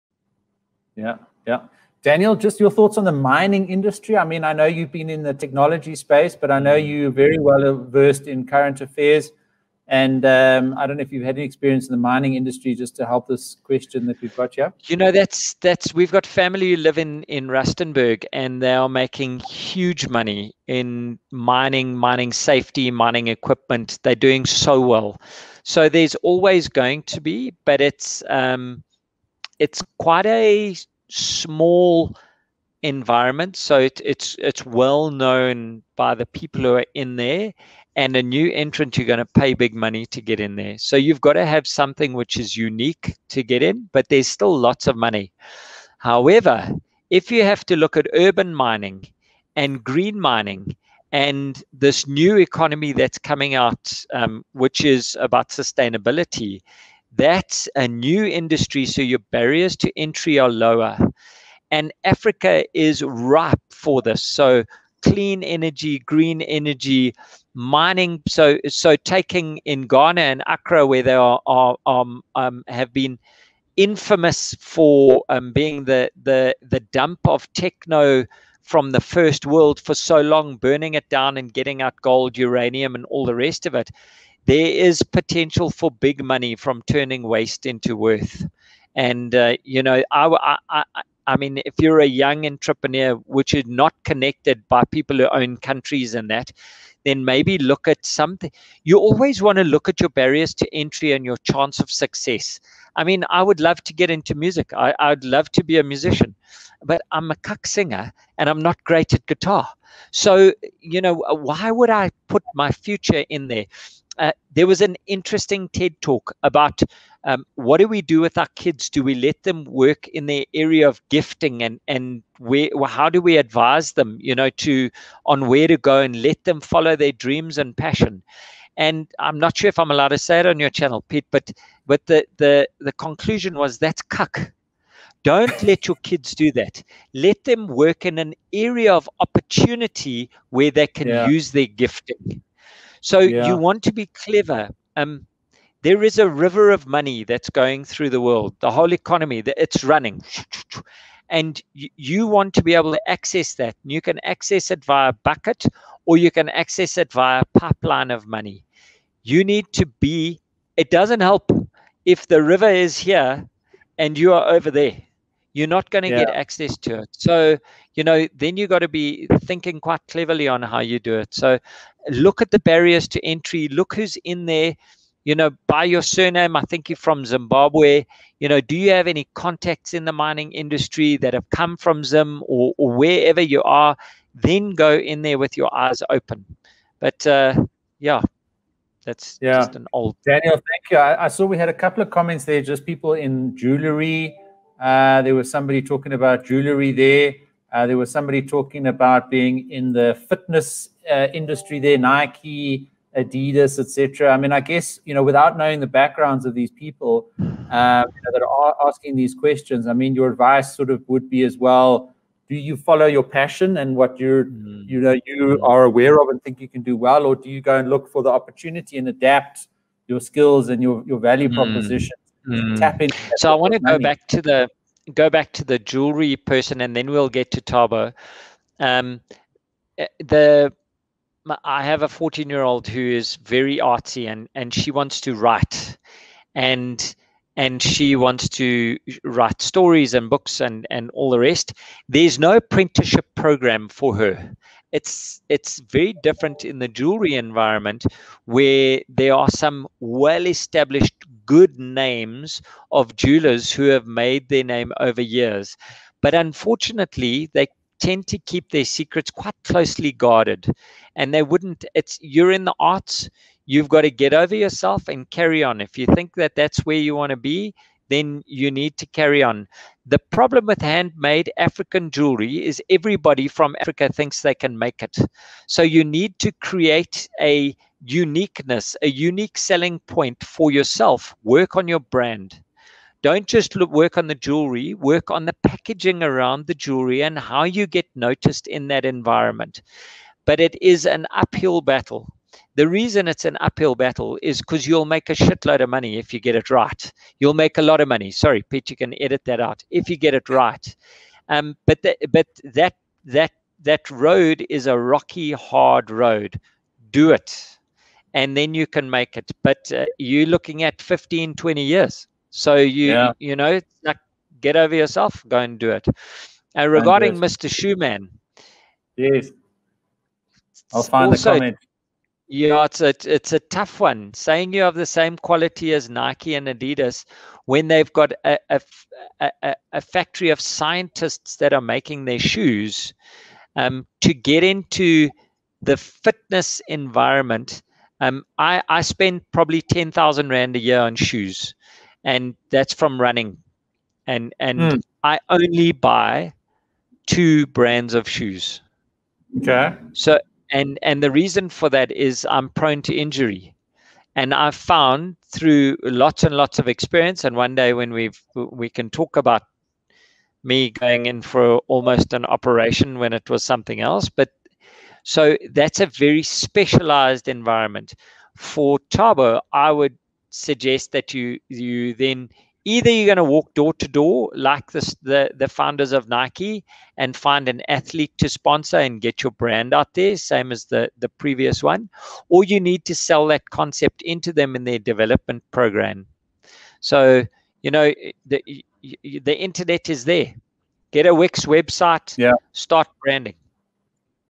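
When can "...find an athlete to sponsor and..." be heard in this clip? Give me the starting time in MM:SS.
06:17.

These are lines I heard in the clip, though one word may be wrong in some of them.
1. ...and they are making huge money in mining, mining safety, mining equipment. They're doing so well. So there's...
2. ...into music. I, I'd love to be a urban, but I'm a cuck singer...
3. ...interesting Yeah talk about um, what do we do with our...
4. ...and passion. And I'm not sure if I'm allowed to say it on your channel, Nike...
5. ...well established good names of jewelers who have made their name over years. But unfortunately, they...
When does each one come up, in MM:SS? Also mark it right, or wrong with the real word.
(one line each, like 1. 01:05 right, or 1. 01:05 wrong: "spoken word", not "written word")
1. 00:18 right
2. 01:44 wrong: "musician", not "urban"
3. 01:55 wrong: "TED", not "Yeah"
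4. 02:07 wrong: "Pete", not "Nike"
5. 04:10 right.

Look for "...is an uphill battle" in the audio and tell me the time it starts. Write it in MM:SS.
04:50.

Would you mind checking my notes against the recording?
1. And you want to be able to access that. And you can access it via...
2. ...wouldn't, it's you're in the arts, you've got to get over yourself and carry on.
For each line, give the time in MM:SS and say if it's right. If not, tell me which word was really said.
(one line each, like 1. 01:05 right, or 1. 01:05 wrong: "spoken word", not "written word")
1. 02:31 right
2. 04:21 right.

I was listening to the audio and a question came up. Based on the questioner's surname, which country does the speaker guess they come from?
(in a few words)
Zimbabwe.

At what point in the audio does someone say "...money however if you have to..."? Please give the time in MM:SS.
00:44.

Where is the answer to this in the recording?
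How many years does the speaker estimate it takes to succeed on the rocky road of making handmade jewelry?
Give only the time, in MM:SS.
05:11.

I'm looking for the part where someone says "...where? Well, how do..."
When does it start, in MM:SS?
02:02.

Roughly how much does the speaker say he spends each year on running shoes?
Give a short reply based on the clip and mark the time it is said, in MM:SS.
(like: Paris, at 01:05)
10,000 Rand, at 05:39.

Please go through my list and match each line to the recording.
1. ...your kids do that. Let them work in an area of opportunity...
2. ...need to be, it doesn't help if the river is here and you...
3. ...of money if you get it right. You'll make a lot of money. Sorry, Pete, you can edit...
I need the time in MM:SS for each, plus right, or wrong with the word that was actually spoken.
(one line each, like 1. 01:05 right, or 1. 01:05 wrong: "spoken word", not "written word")
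1. 02:15 right
2. 02:39 right
3. 04:55 right.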